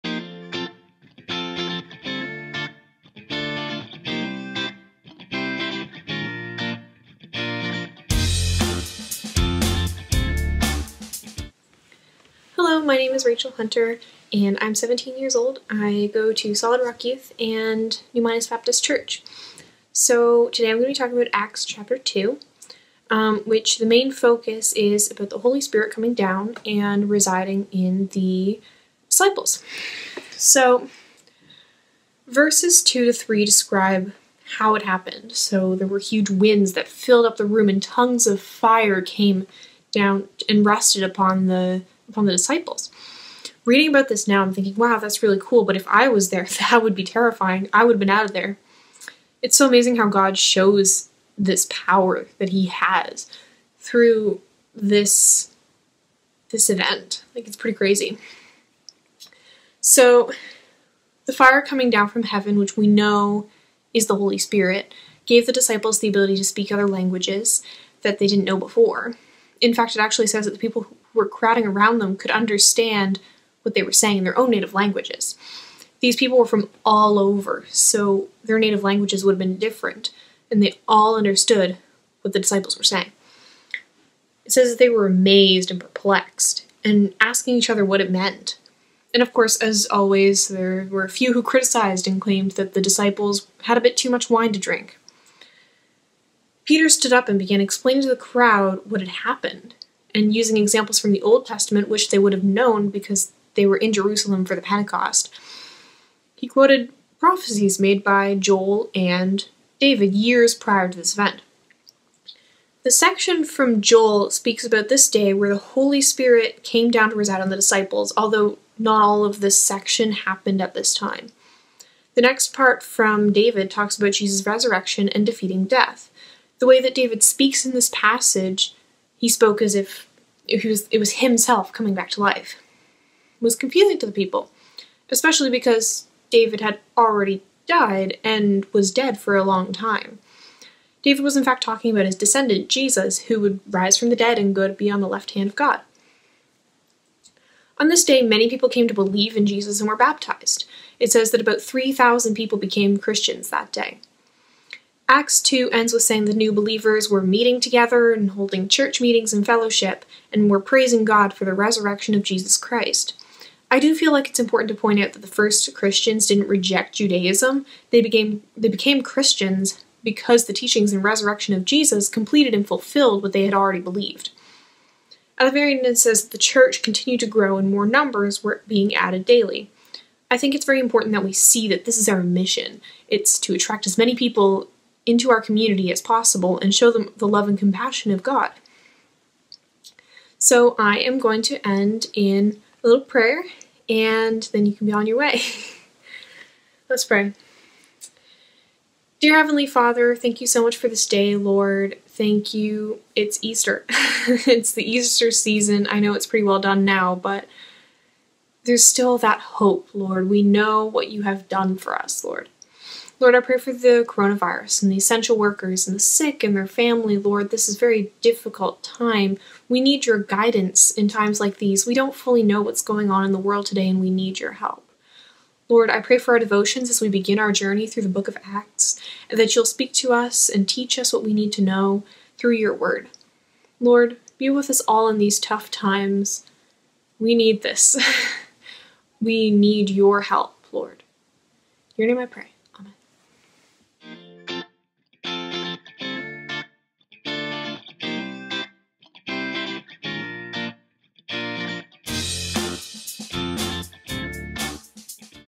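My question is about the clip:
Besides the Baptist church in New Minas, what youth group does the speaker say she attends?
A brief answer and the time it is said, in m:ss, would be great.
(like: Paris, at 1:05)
Solid Rock Youth, at 0:16.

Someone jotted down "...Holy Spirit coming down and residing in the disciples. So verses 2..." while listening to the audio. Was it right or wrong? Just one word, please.
right.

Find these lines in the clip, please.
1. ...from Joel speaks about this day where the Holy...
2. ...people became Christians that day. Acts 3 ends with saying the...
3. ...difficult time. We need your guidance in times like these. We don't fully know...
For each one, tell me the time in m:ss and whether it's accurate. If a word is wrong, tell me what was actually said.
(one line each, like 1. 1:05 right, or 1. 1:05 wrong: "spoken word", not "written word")
1. 1:53 right
2. 2:32 wrong: "2", not "3"
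3. 3:38 right.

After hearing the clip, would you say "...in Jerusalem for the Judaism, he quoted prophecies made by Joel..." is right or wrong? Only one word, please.
wrong.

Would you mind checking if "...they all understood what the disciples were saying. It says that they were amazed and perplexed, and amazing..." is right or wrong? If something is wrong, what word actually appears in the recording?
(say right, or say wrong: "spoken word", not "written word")
wrong: "asking", not "amazing".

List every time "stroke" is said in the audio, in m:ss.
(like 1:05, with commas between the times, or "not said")
not said.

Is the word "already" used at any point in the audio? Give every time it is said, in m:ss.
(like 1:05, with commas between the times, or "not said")
2:16, 2:53.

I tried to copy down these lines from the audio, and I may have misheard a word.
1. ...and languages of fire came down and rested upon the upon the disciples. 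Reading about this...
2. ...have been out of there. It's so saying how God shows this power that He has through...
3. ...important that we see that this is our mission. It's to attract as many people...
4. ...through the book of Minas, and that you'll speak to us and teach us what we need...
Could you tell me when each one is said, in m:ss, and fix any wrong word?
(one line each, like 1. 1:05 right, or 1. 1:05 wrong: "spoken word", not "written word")
1. 0:37 wrong: "tongues", not "languages"
2. 0:47 wrong: "amazing", not "saying"
3. 3:00 right
4. 3:47 wrong: "Acts", not "Minas".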